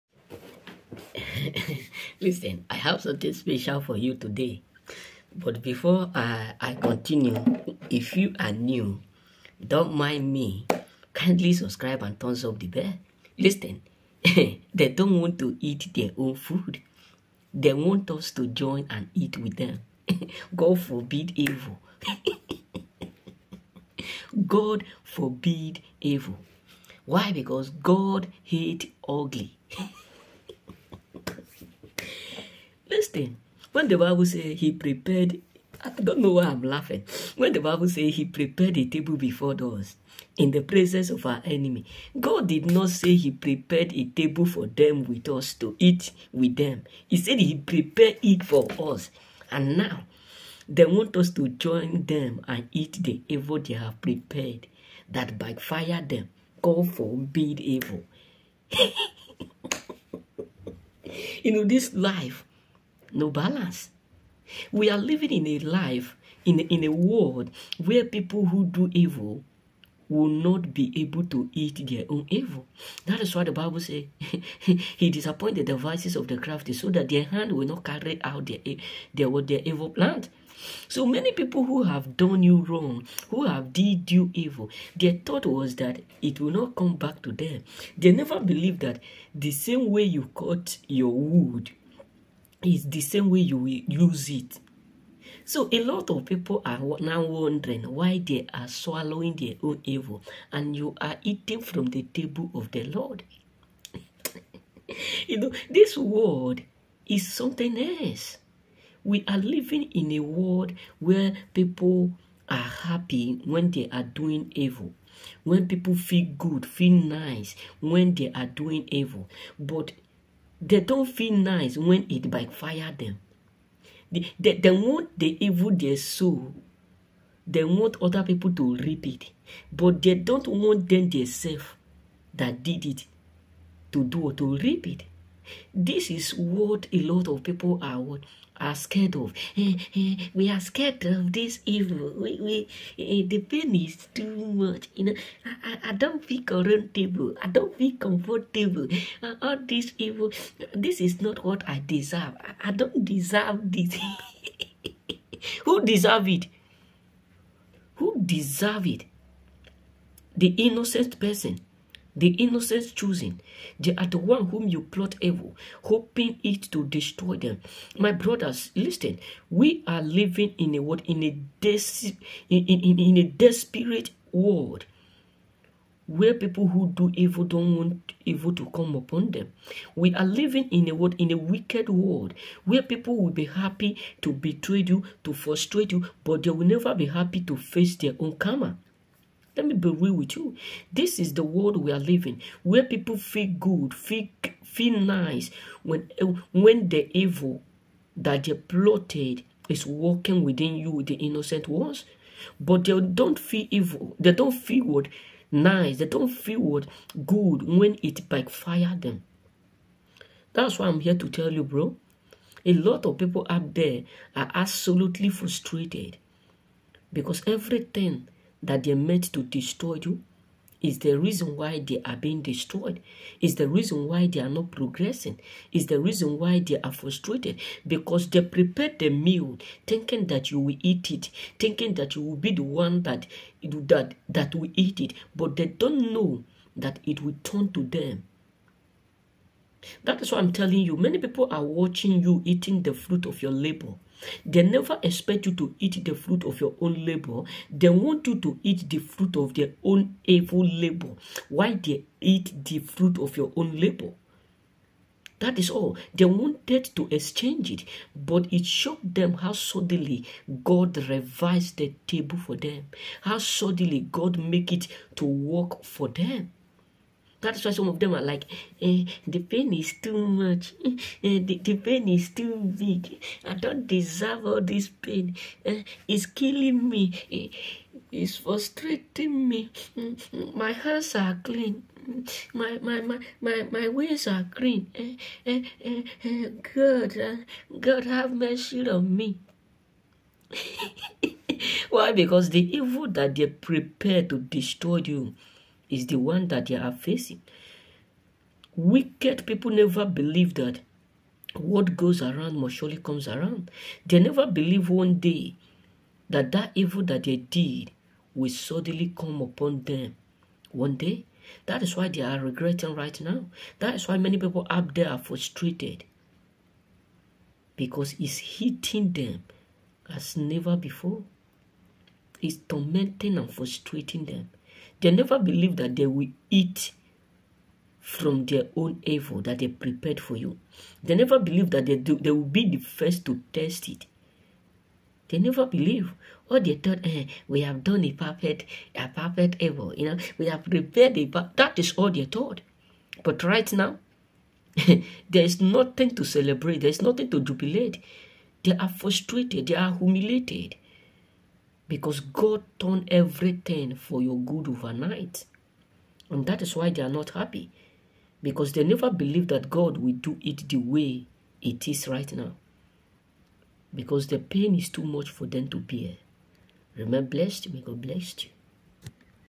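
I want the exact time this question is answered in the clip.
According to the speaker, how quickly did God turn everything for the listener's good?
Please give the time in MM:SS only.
05:54.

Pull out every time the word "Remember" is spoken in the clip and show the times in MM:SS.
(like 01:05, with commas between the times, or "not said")
06:06.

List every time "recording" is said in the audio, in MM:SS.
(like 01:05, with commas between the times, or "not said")
not said.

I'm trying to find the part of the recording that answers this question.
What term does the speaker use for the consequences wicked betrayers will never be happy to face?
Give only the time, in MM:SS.
03:08.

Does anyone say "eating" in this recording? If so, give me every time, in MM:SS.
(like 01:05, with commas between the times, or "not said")
01:41, 04:02.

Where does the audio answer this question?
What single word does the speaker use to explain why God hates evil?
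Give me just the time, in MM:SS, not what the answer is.
00:27.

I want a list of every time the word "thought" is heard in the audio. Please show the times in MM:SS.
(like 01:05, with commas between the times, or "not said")
01:25, 05:36, 05:42.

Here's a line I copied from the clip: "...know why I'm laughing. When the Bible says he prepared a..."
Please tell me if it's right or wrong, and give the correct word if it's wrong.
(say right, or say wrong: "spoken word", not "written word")
right.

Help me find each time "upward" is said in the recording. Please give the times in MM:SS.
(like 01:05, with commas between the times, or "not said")
not said.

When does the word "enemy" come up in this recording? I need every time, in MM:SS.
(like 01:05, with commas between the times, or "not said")
00:41.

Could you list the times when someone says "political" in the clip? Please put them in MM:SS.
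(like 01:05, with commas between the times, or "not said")
not said.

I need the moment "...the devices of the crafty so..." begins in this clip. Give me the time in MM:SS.
01:15.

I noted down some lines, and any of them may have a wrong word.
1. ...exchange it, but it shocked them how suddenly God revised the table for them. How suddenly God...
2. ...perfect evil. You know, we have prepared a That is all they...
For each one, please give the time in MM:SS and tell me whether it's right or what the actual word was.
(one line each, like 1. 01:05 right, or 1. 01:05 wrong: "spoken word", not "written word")
1. 04:17 right
2. 05:39 right.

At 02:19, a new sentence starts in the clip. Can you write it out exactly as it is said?
Eh, eh, we are scared of this evil.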